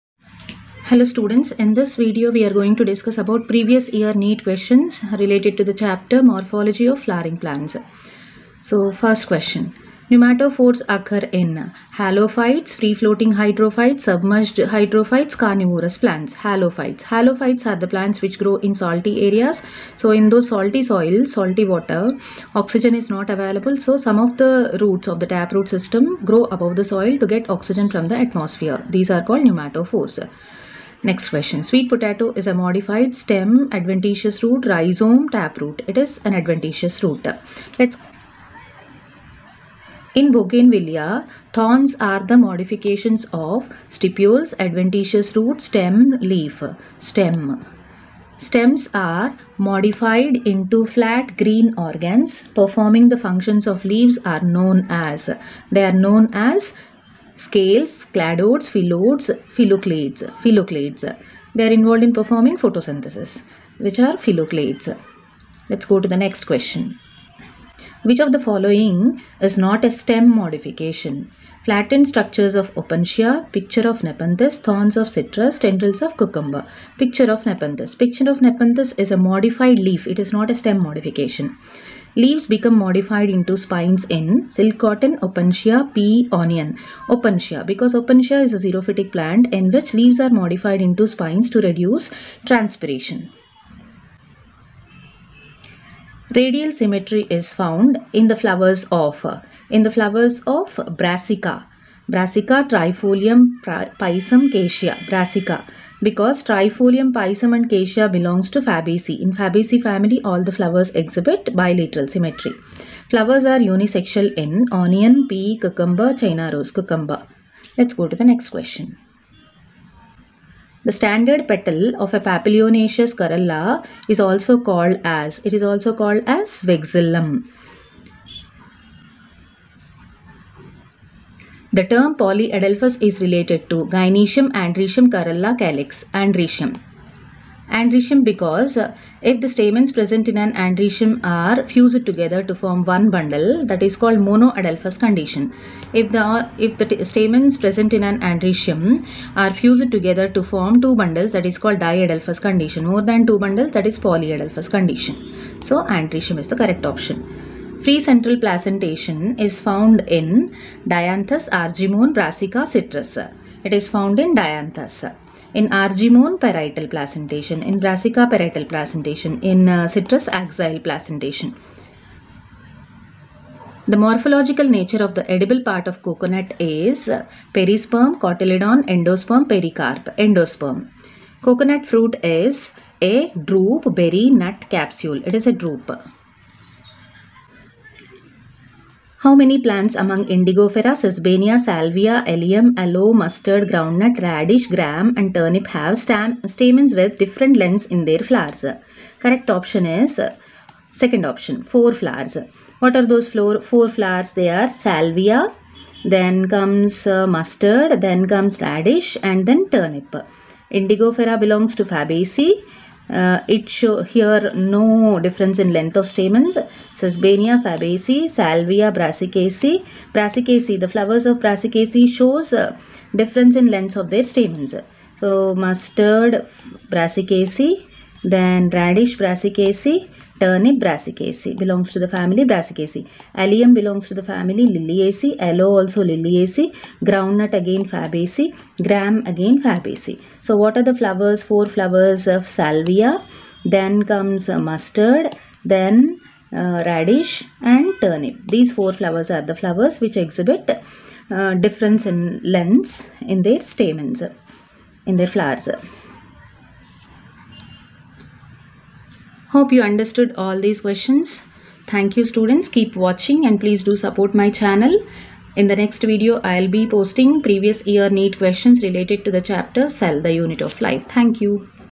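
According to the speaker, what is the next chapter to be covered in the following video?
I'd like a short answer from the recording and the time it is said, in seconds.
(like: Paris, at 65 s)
Cell, the Unit of Life, at 269 s.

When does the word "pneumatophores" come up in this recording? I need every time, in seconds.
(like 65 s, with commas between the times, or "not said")
10 s, 29 s.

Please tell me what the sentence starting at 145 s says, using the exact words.
If the, if the stamens present in an androecium are fused together to form two bundles that is called diadelphous condition.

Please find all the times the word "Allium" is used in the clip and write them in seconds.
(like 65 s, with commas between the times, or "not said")
192 s, 233 s.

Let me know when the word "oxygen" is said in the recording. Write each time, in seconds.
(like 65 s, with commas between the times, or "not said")
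22 s, 27 s.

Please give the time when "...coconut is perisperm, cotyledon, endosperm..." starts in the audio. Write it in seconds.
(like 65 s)
176 s.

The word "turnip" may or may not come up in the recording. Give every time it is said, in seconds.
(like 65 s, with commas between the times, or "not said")
195 s, 209 s, 230 s, 248 s.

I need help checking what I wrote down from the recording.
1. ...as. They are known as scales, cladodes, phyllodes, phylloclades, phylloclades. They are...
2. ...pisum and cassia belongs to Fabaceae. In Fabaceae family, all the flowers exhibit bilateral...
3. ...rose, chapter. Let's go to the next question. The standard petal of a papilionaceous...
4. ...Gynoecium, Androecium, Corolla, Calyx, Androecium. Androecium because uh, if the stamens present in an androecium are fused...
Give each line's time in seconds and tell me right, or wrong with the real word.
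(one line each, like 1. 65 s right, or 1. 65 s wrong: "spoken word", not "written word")
1. 54 s right
2. 107 s right
3. 116 s wrong: "cucumber", not "chapter"
4. 133 s right.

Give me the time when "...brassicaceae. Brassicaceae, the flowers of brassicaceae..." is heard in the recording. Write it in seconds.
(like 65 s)
218 s.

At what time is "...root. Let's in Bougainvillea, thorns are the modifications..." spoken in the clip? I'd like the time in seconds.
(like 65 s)
37 s.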